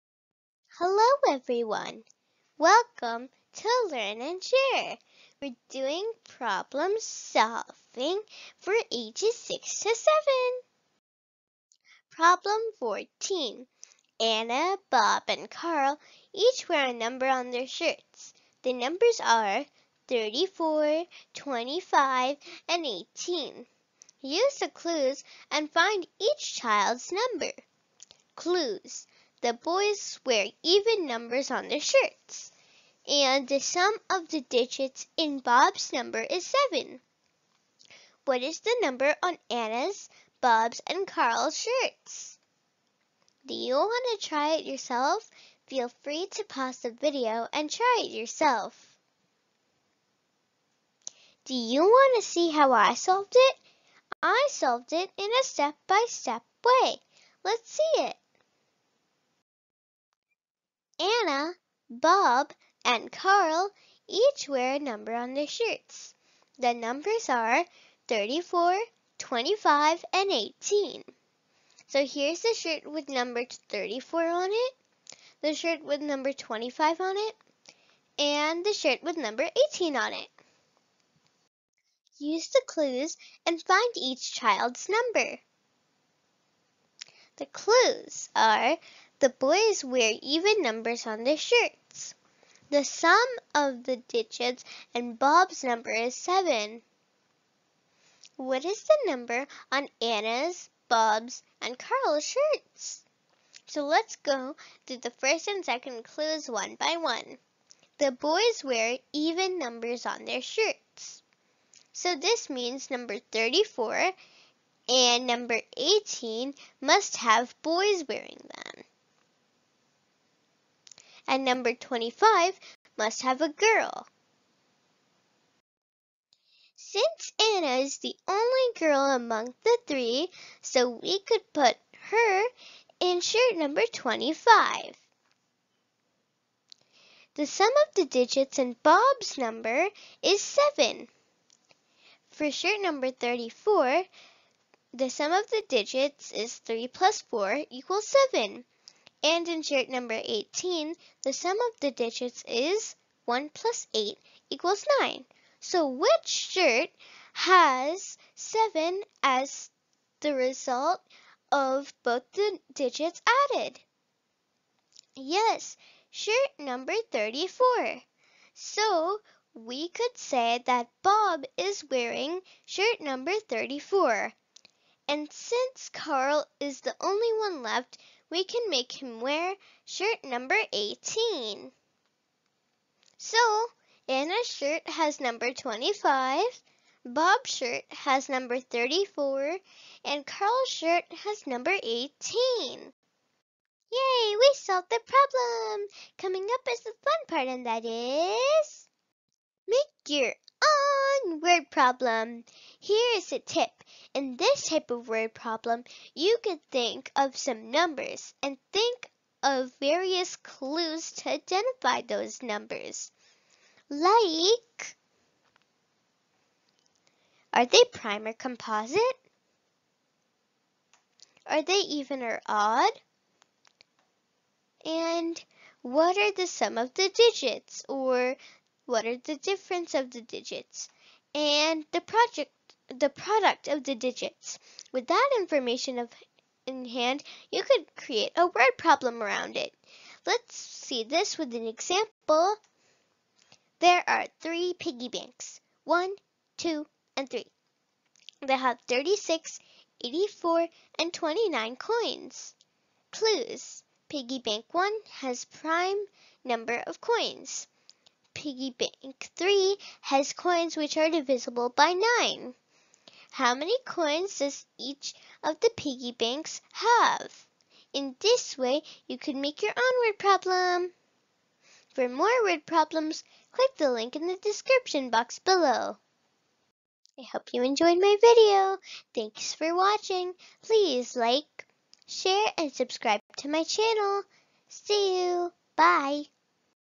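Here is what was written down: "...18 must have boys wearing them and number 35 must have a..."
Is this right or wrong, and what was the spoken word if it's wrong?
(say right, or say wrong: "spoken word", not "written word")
wrong: "25", not "35".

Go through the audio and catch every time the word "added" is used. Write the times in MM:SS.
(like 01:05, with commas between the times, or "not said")
02:43.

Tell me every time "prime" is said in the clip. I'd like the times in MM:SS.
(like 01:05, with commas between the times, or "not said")
03:37, 04:15.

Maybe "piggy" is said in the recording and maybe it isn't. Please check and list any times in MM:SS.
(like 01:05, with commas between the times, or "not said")
04:04, 04:14, 04:18, 04:25.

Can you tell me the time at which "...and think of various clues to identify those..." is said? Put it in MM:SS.
03:28.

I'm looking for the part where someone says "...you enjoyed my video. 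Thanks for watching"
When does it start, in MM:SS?
04:37.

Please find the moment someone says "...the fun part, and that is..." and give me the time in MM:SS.
03:16.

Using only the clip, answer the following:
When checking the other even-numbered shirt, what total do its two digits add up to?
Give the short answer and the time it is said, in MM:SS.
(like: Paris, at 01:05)
9, at 02:33.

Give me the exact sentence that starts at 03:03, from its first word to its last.
So, Ana's shirt has number 25, Bob's shirt has number 34, and Carl's shirt has number 18.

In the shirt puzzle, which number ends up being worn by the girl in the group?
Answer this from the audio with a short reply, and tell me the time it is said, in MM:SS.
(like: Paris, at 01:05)
25, at 02:06.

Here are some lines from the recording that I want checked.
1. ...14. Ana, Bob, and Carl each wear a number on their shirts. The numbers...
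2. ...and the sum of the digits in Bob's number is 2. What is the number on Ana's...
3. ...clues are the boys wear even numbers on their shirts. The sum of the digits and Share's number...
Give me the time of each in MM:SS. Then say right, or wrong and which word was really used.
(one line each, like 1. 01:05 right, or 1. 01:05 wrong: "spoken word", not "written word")
1. 00:12 right
2. 00:33 wrong: "7", not "2"
3. 01:27 wrong: "Bob", not "Share".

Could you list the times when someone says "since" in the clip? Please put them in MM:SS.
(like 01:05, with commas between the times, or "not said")
02:06, 02:55.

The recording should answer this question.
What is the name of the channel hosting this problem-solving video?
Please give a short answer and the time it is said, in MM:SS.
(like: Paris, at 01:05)
Learn and Share, at 00:03.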